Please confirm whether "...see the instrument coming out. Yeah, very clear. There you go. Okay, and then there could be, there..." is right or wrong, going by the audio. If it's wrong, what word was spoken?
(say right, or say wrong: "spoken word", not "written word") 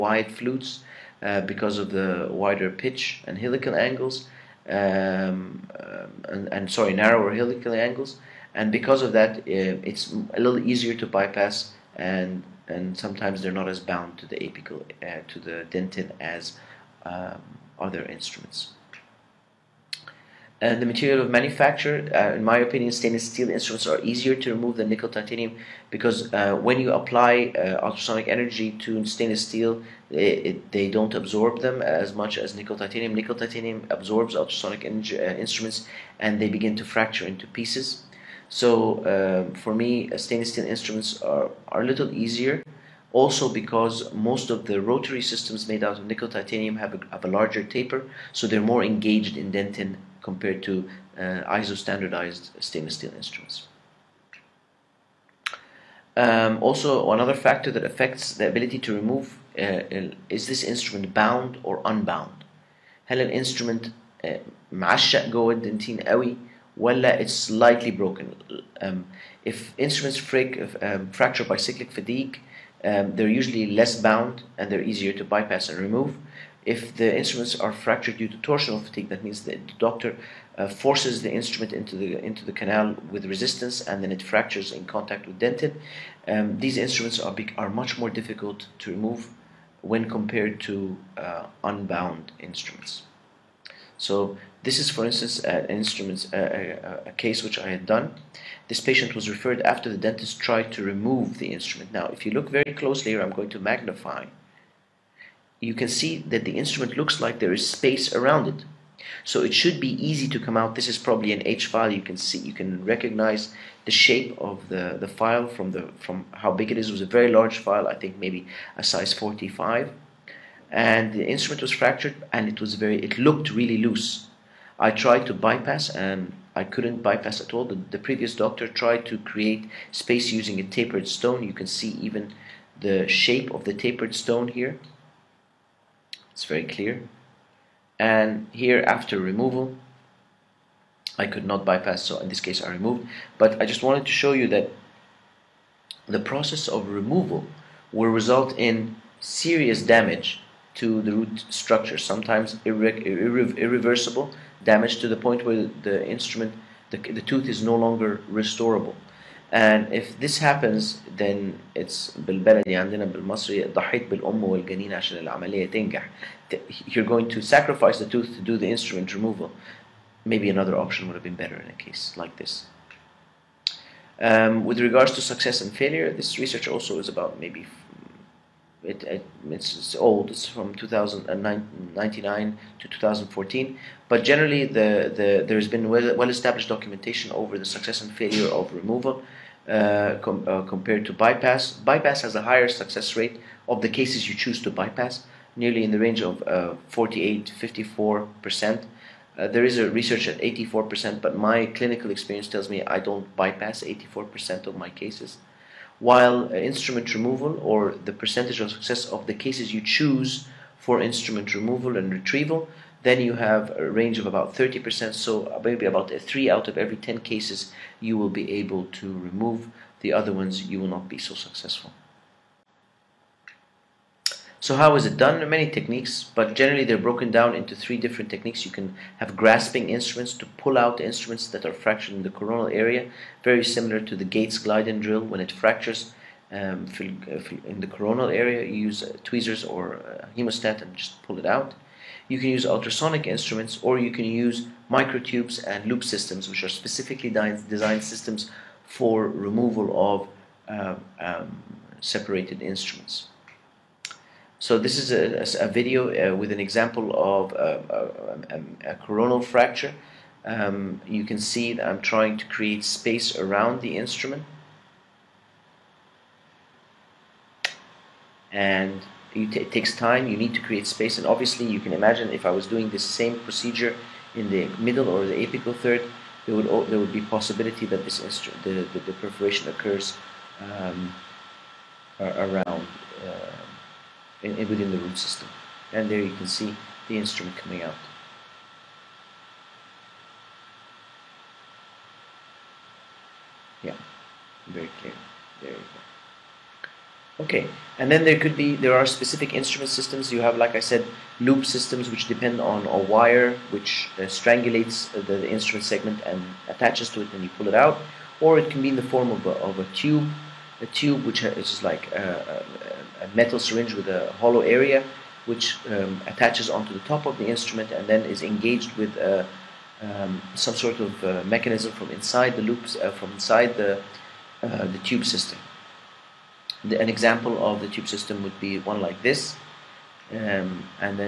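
right.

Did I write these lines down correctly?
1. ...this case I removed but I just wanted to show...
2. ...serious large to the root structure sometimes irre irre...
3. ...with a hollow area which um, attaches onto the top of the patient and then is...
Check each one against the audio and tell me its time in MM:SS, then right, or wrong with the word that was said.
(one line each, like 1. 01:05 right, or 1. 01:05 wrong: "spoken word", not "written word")
1. 02:22 right
2. 02:29 wrong: "damage", not "large"
3. 05:13 wrong: "instrument", not "patient".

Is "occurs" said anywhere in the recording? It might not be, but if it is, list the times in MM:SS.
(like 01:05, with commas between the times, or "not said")
04:39.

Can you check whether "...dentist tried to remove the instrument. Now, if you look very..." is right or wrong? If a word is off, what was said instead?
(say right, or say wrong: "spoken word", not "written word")
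right.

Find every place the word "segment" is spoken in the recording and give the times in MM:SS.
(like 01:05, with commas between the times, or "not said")
05:05.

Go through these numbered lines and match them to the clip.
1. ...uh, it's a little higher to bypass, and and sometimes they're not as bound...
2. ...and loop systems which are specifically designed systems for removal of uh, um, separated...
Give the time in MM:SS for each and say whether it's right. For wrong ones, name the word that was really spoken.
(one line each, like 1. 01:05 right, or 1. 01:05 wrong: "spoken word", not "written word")
1. 00:09 wrong: "easier", not "higher"
2. 04:05 right.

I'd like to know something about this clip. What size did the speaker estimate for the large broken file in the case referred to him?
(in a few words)
45.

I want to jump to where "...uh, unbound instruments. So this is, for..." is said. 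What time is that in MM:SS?
01:31.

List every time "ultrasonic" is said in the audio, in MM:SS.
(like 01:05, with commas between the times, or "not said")
00:27, 00:34, 04:02.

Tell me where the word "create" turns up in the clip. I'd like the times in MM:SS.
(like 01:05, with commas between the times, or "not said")
02:09, 04:22, 04:30.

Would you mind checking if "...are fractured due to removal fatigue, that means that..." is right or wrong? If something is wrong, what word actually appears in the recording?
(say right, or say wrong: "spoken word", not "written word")
wrong: "torsional", not "removal".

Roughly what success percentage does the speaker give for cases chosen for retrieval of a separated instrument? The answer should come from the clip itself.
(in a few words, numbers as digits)
30%.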